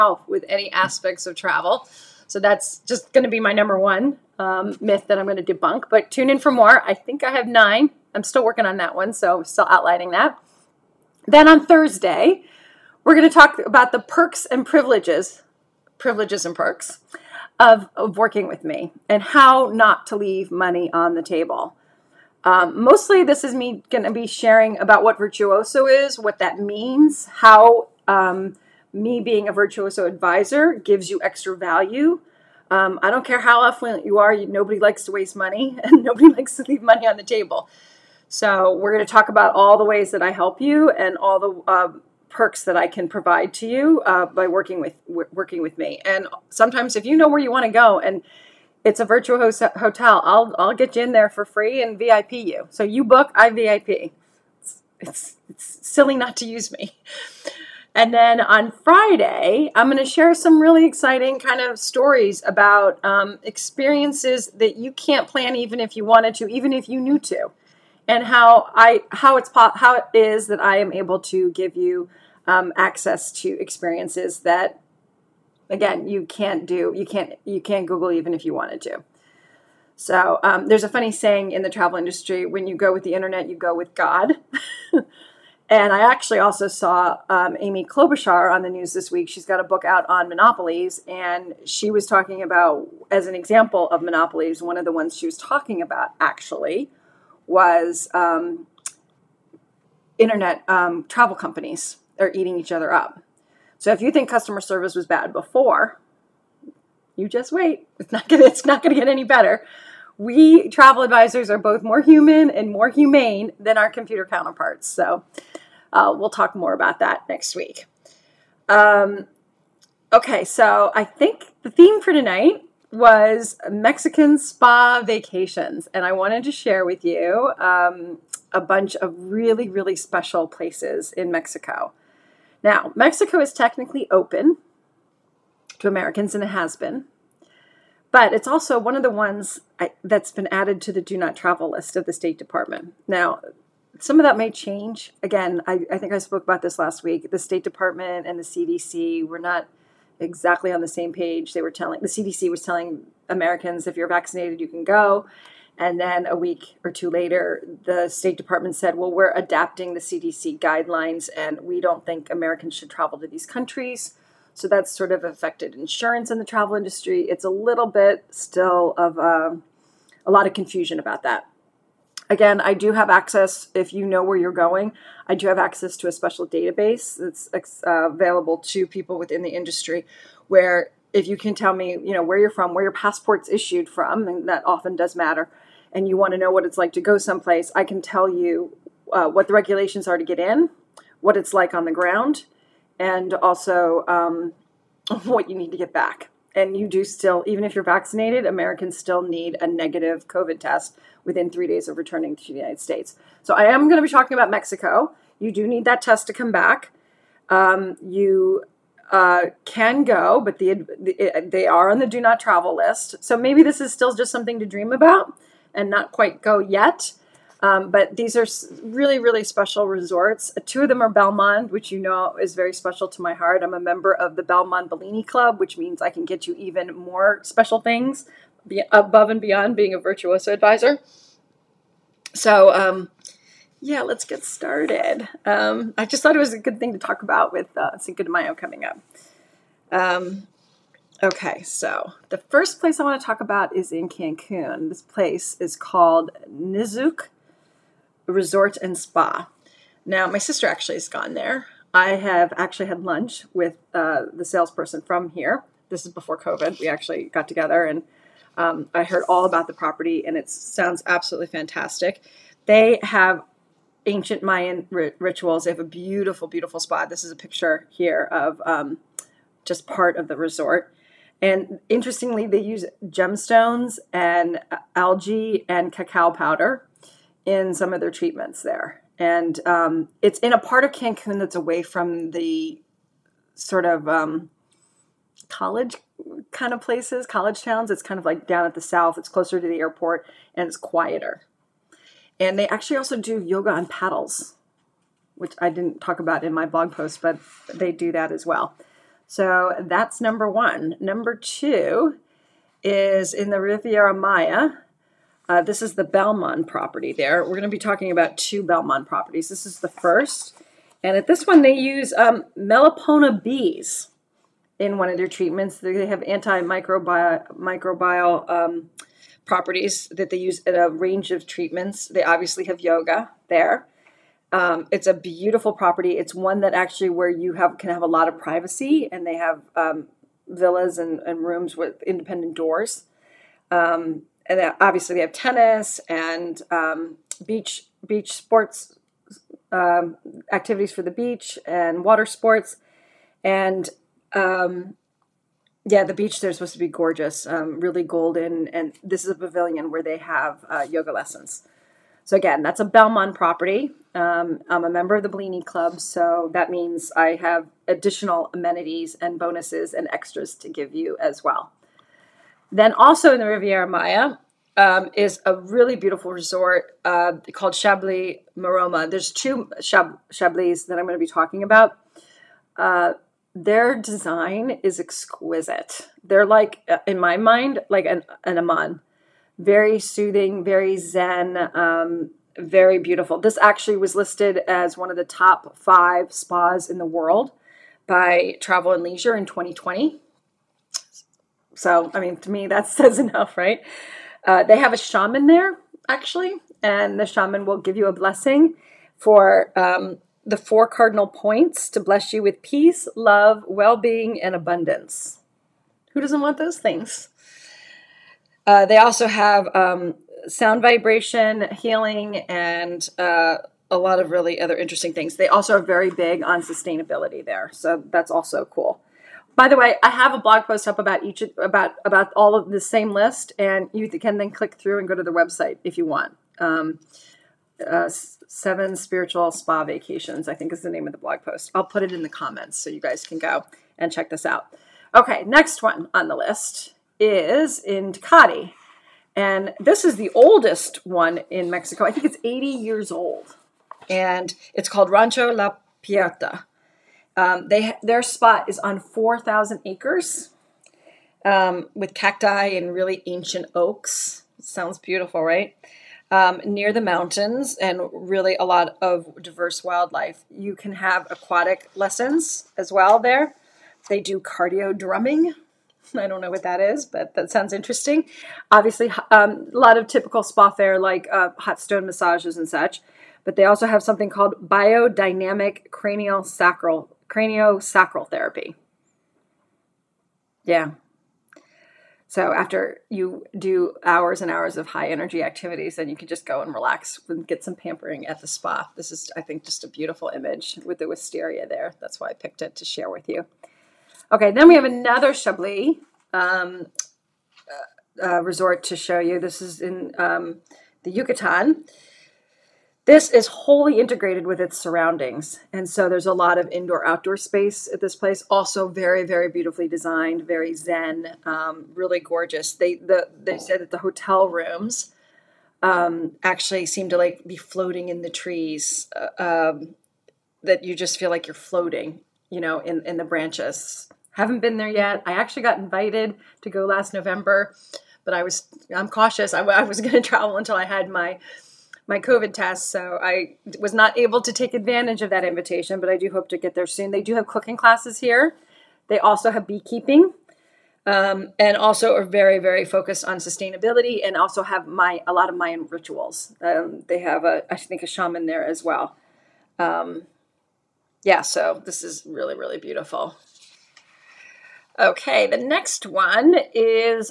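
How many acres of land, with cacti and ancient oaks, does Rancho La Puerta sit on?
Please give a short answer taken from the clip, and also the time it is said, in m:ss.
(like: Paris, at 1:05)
4,000, at 7:28.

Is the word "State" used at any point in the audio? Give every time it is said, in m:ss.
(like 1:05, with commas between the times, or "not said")
2:22, 2:27, 2:38, 3:22.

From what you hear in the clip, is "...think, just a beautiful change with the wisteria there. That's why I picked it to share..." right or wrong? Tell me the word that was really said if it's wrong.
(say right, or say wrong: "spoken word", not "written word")
wrong: "image", not "change".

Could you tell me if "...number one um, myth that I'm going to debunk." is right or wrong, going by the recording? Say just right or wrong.
right.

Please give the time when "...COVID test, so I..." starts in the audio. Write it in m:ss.
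8:52.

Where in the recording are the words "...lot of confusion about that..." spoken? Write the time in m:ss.
2:50.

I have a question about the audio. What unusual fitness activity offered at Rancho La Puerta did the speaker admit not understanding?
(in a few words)
cardio drumming.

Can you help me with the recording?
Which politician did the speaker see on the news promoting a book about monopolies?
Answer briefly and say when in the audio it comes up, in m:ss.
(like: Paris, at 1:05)
Amy Klobuchar, at 1:27.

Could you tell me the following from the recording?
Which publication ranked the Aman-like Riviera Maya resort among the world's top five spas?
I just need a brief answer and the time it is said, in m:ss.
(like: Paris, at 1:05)
Travel and Leisure, at 6:28.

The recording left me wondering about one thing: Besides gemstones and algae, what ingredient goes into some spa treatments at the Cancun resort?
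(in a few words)
cacao powder.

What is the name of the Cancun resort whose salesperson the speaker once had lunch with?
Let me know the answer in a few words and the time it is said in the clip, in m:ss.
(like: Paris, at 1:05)
Nizuc Resort and Spa, at 4:06.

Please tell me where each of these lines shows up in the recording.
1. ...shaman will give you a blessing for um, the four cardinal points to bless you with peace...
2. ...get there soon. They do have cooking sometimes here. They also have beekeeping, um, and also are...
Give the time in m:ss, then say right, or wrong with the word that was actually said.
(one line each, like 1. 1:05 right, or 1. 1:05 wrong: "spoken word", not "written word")
1. 6:37 right
2. 8:56 wrong: "classes", not "sometimes".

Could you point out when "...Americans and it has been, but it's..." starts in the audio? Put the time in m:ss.
2:15.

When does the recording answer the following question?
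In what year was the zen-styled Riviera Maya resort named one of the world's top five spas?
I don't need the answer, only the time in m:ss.
6:29.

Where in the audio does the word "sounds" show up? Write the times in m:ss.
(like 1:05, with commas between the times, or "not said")
4:20, 6:50, 7:34, 7:47.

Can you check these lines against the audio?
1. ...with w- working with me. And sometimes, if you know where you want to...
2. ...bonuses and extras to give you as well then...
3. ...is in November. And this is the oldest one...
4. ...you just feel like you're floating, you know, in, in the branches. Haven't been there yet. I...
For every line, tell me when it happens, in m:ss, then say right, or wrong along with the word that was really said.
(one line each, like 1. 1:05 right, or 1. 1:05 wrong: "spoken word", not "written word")
1. 0:44 right
2. 5:59 right
3. 7:17 wrong: "Tecate", not "November"
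4. 8:40 right.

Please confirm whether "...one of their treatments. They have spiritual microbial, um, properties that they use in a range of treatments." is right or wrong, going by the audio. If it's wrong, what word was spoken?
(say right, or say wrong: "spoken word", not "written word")
wrong: "antimicrobial", not "spiritual".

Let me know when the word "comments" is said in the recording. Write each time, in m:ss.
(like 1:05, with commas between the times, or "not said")
7:12.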